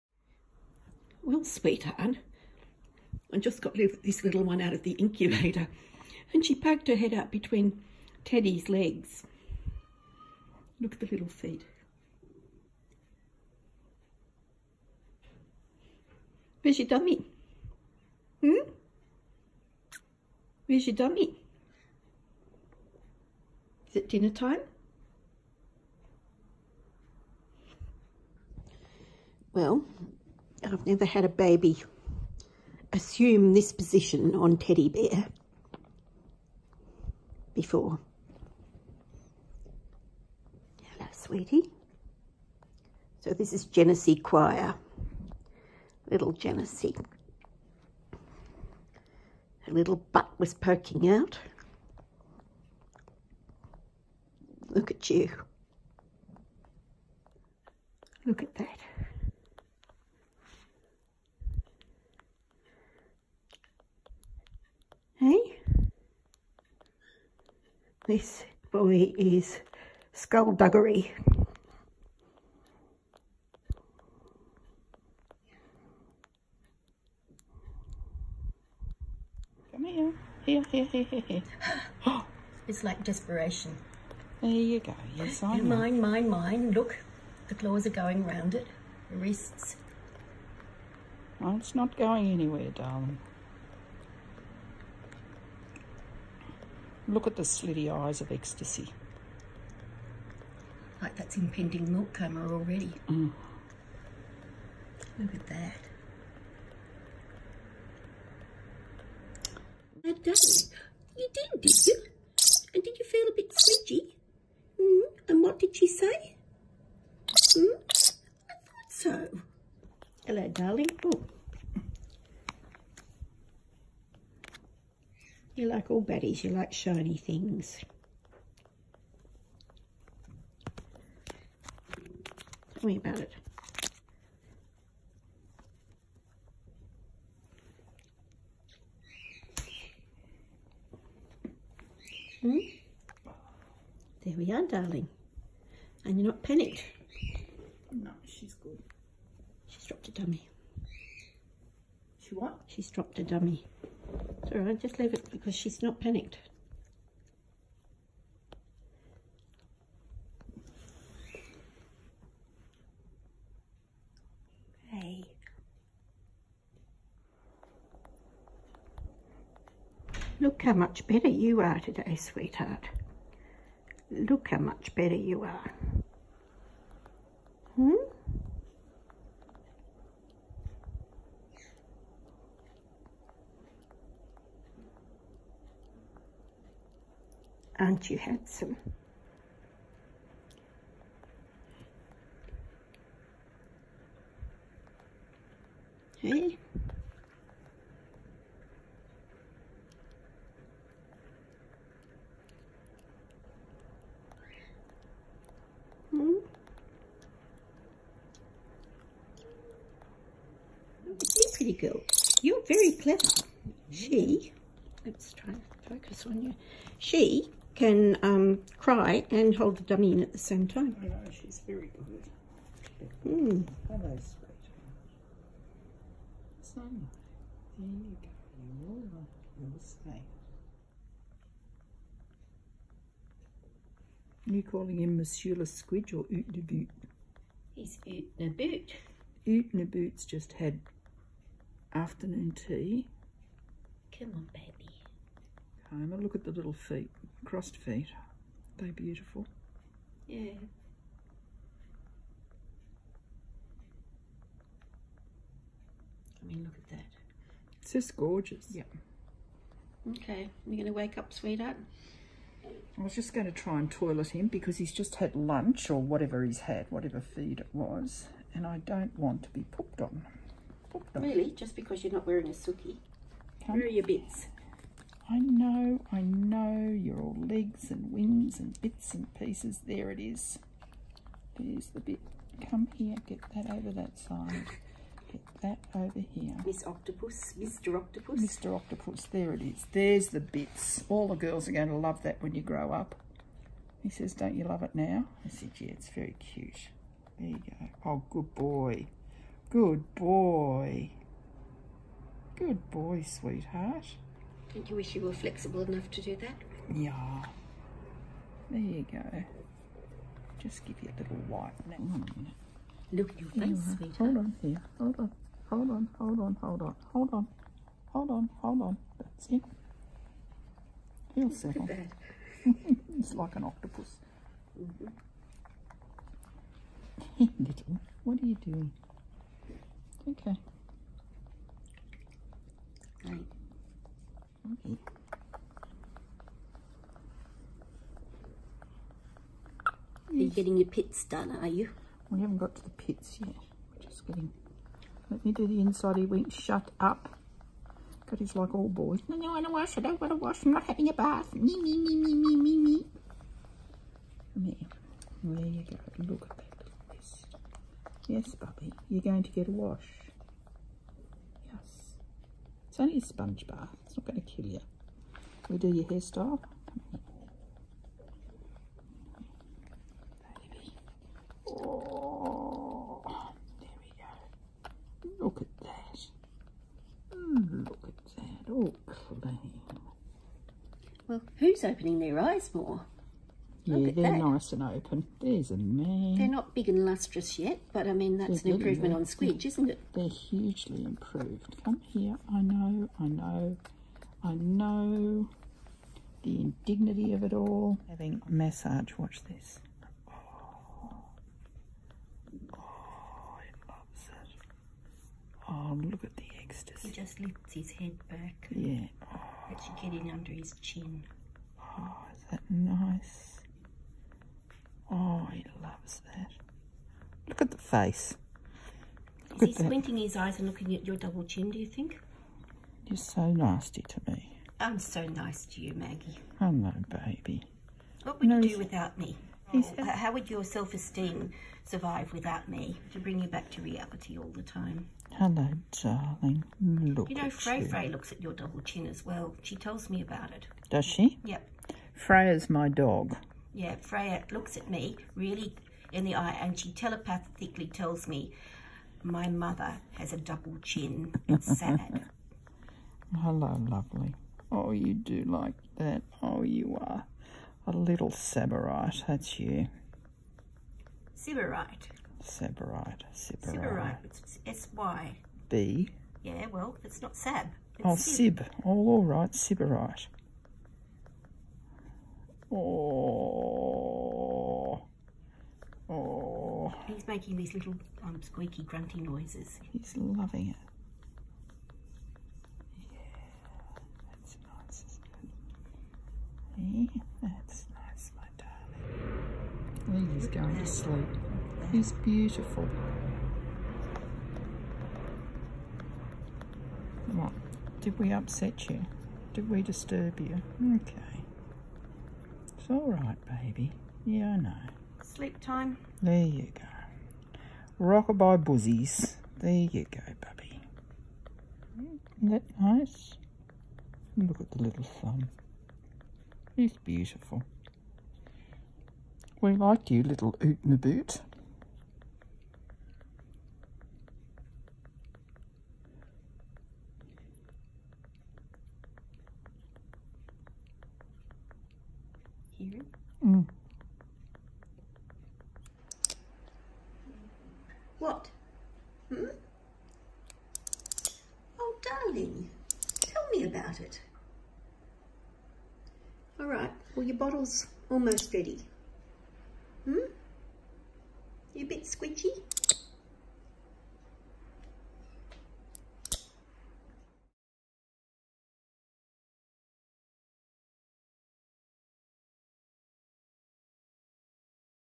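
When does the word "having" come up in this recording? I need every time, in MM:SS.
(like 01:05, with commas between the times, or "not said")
05:50, 06:38.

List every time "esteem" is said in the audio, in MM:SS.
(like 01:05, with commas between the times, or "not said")
07:10.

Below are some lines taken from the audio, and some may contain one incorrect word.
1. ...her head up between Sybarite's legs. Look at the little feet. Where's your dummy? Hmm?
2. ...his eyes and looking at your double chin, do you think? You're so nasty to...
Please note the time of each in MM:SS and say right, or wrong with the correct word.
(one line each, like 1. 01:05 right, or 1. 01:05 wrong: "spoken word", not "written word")
1. 00:06 wrong: "Teddy", not "Sybarite"
2. 07:00 right.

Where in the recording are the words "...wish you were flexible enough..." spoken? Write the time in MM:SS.
05:04.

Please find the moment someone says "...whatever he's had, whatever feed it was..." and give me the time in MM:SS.
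04:26.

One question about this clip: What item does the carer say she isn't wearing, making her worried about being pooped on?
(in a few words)
a suki.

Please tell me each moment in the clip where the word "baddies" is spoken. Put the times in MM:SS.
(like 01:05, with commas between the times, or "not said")
02:06.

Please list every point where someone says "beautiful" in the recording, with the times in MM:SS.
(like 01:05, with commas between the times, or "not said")
04:08, 08:12, 08:36.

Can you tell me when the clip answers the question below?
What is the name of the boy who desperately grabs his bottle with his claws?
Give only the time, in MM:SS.
01:10.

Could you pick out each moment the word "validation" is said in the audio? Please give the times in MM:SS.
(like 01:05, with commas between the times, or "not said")
not said.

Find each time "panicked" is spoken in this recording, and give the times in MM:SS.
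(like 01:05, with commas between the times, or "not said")
02:26, 02:36.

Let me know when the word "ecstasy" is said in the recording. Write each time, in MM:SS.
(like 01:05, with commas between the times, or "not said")
01:38, 06:46.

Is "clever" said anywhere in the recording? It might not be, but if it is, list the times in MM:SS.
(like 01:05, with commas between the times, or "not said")
03:32.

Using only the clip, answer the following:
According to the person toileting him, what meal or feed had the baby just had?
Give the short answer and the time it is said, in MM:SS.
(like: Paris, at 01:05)
afternoon tea, at 04:01.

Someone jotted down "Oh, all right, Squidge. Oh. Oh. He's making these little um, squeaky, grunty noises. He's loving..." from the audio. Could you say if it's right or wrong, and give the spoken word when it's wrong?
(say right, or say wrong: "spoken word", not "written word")
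wrong: "Sybarite", not "Squidge".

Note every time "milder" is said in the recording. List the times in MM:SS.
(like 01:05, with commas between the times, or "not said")
not said.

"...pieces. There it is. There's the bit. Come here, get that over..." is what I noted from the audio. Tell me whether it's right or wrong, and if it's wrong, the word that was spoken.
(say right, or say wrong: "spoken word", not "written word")
right.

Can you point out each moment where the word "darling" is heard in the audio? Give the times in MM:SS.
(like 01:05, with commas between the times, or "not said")
01:32, 02:00, 02:24, 07:16, 09:02.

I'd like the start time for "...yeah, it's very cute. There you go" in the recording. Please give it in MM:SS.
04:55.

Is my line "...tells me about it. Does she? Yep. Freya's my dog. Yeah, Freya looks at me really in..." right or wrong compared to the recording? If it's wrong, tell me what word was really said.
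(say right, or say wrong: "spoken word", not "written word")
right.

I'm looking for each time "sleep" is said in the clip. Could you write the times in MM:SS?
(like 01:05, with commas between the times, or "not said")
08:10, 08:25.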